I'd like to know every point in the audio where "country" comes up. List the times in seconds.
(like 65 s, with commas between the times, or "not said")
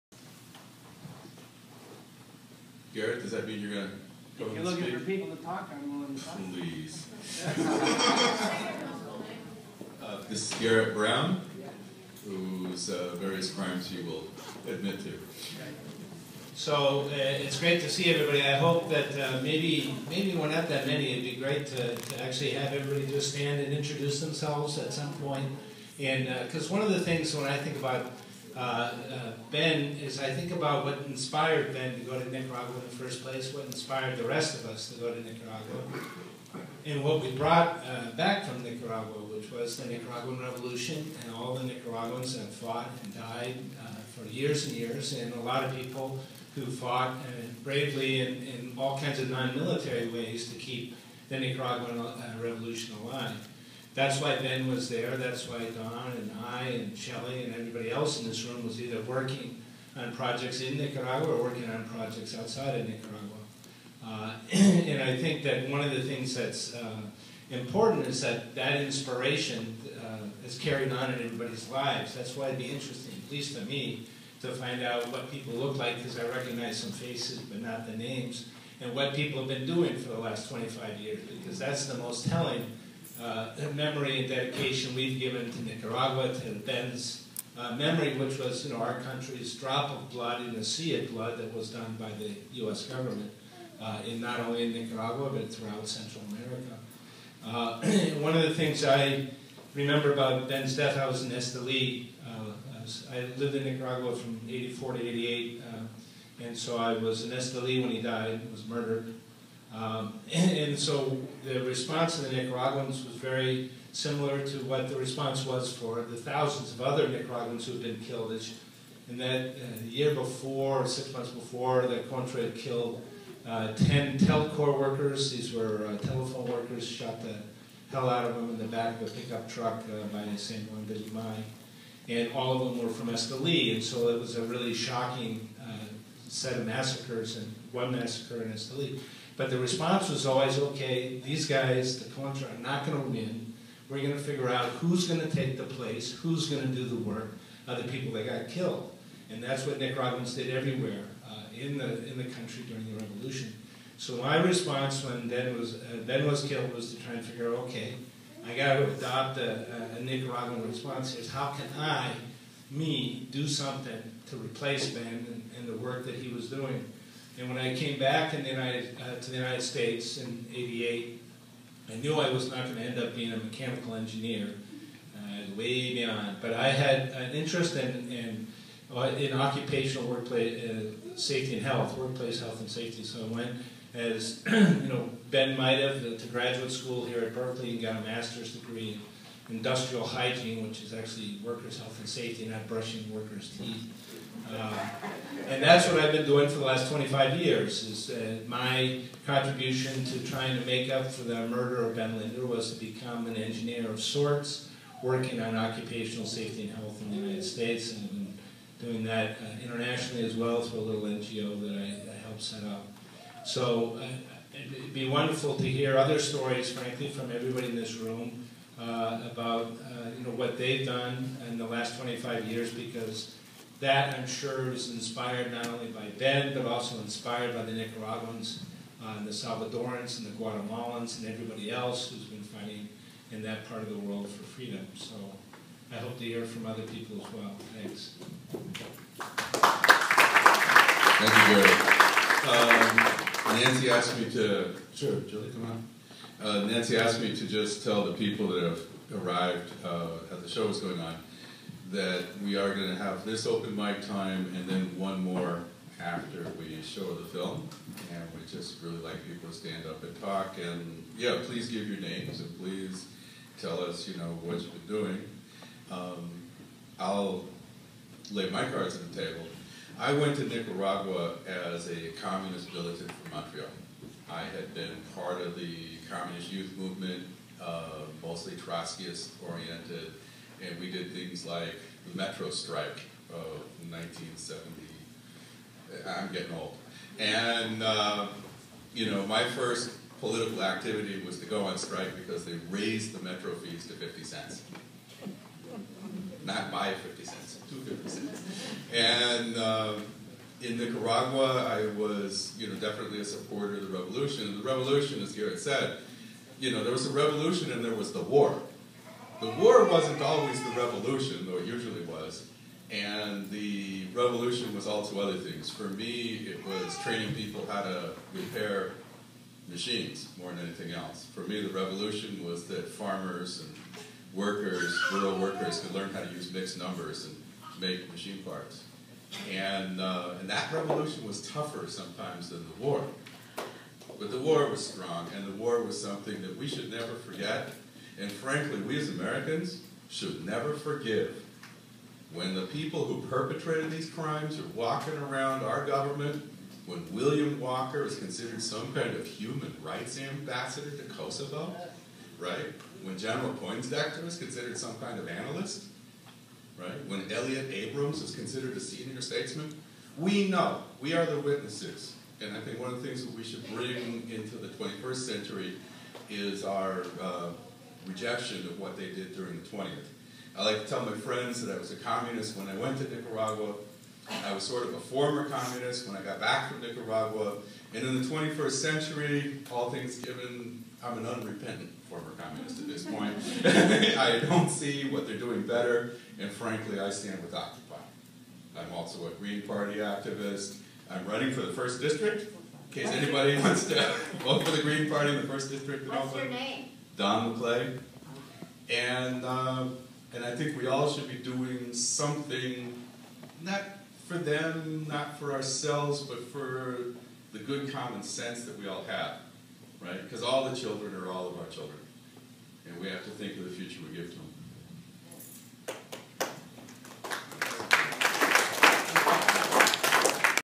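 89 s, 152 s.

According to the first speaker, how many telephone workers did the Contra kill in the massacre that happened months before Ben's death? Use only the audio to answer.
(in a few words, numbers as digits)
10.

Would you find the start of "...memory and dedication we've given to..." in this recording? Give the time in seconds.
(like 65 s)
83 s.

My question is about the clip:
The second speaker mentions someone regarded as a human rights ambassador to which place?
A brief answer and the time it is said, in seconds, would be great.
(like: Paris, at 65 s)
Kosovo, at 351 s.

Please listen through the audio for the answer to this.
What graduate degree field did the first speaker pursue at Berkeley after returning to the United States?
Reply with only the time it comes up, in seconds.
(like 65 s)
189 s.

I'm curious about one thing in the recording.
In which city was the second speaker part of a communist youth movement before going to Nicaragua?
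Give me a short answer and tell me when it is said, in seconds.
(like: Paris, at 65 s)
Montreal, at 273 s.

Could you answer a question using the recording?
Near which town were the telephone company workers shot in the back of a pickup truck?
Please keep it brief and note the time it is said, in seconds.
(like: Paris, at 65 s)
San Juan de Limay, at 130 s.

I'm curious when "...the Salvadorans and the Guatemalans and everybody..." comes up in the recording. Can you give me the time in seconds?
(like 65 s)
229 s.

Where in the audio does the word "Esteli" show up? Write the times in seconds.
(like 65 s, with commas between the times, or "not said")
101 s, 107 s, 133 s, 138 s.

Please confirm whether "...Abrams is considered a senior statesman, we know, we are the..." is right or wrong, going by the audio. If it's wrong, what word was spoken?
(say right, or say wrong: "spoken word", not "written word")
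right.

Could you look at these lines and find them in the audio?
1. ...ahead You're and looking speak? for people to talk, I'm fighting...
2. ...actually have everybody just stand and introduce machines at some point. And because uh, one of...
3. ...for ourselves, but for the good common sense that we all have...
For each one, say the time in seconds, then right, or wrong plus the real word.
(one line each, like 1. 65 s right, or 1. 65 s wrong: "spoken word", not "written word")
1. 4 s wrong: "willing", not "fighting"
2. 22 s wrong: "themselves", not "machines"
3. 405 s right.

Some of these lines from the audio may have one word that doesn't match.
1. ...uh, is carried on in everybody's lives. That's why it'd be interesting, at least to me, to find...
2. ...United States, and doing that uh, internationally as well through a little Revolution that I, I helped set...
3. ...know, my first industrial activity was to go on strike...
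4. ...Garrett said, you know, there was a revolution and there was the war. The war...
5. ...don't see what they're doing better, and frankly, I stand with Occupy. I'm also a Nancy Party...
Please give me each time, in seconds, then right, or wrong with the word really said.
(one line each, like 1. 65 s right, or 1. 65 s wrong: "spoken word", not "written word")
1. 70 s right
2. 207 s wrong: "NGO", not "Revolution"
3. 289 s wrong: "political", not "industrial"
4. 305 s right
5. 384 s wrong: "Green", not "Nancy".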